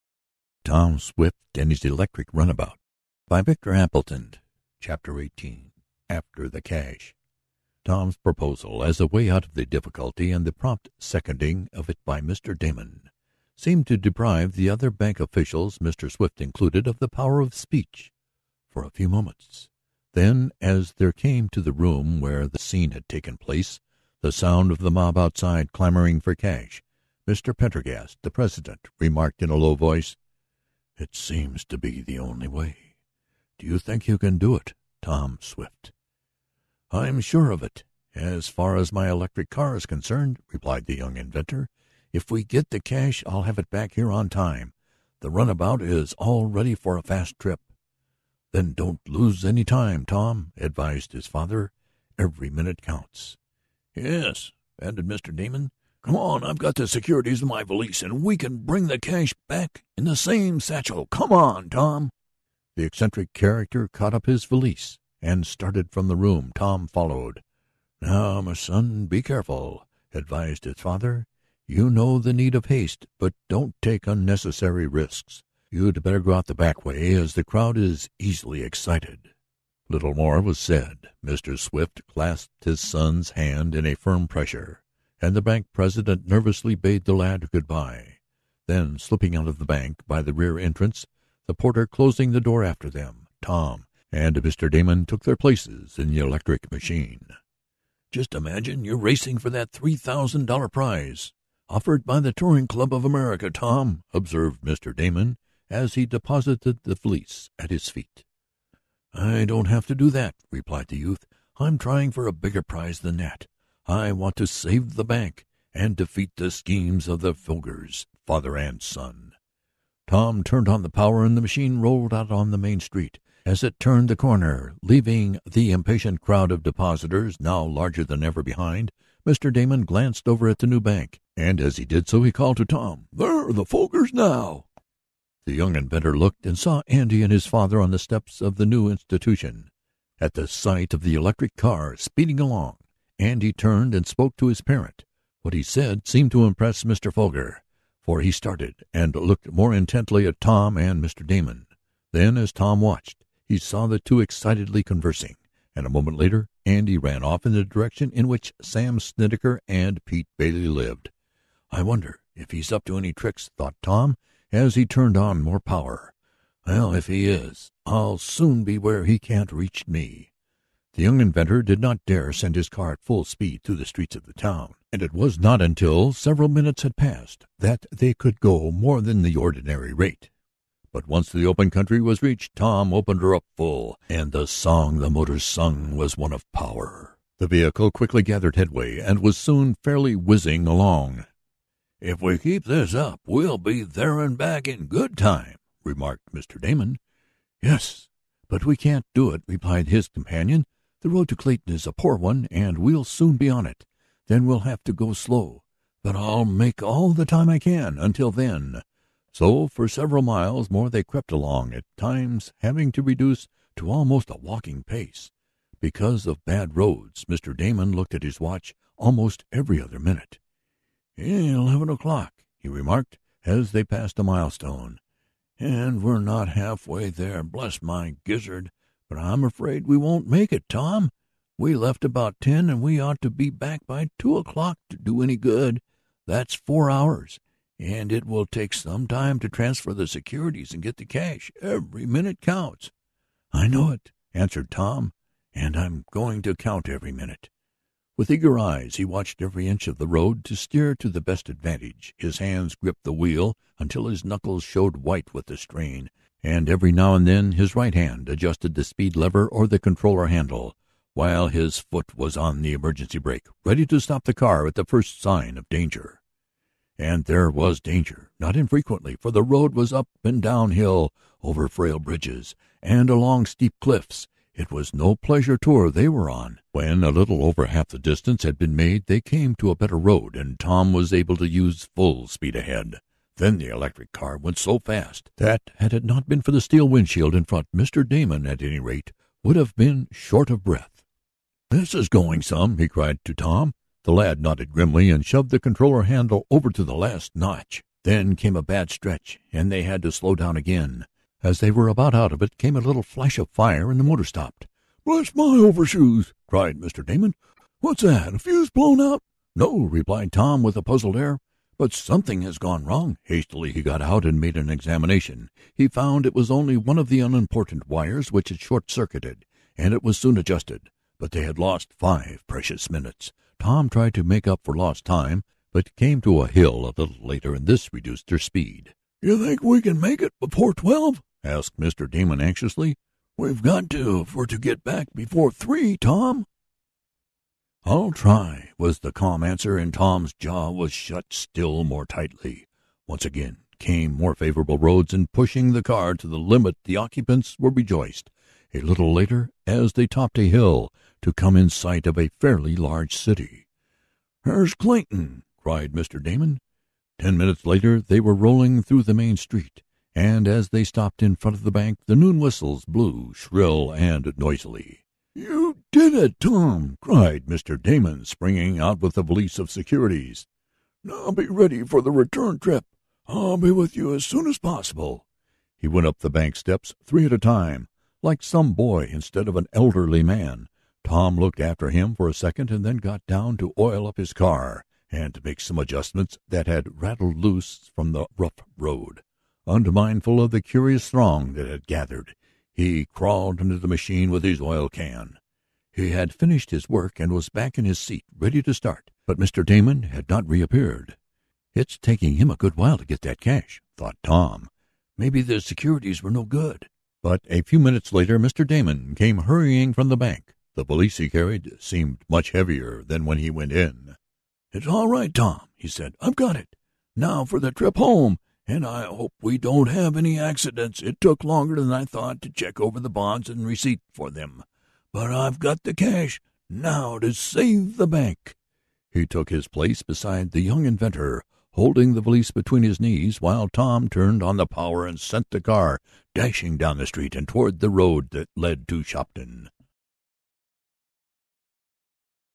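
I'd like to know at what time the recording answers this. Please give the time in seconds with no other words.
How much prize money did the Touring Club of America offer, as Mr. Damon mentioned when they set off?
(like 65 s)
99 s.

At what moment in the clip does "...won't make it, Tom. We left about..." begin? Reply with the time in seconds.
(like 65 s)
229 s.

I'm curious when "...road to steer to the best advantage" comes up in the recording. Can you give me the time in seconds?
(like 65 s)
250 s.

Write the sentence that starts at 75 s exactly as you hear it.
You'd better go out the back way, as the crowd is easily excited." Little more was said.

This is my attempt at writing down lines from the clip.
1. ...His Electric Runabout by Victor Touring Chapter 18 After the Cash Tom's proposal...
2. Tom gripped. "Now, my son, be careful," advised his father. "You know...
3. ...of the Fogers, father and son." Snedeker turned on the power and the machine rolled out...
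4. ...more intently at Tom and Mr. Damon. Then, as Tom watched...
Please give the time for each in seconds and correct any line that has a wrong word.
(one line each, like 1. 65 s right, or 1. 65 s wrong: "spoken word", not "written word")
1. 1 s wrong: "Appleton", not "Touring"
2. 66 s wrong: "followed", not "gripped"
3. 117 s wrong: "Tom", not "Snedeker"
4. 149 s right.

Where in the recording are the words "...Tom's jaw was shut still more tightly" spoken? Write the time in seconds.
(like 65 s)
339 s.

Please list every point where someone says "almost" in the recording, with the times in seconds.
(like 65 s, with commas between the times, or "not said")
213 s, 218 s.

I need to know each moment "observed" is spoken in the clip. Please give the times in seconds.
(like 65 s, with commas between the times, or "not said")
104 s.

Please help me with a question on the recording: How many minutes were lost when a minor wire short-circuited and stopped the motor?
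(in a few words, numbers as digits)
5.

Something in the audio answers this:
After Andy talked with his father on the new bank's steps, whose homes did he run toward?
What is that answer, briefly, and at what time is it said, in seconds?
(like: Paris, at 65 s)
Sam Snedeker, at 158 s.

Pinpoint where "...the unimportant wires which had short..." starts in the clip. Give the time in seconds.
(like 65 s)
317 s.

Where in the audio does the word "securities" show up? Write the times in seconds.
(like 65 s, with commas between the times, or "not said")
56 s, 240 s, 369 s, 405 s.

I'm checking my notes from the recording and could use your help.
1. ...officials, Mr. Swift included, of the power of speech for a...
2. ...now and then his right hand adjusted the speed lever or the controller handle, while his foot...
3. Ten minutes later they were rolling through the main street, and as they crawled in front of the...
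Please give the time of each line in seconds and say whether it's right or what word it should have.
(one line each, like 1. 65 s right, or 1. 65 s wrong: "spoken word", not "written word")
1. 15 s right
2. 256 s right
3. 357 s wrong: "stopped", not "crawled".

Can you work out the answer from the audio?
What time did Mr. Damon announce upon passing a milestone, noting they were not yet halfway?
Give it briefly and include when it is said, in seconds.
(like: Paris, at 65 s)
11 o'clock, at 221 s.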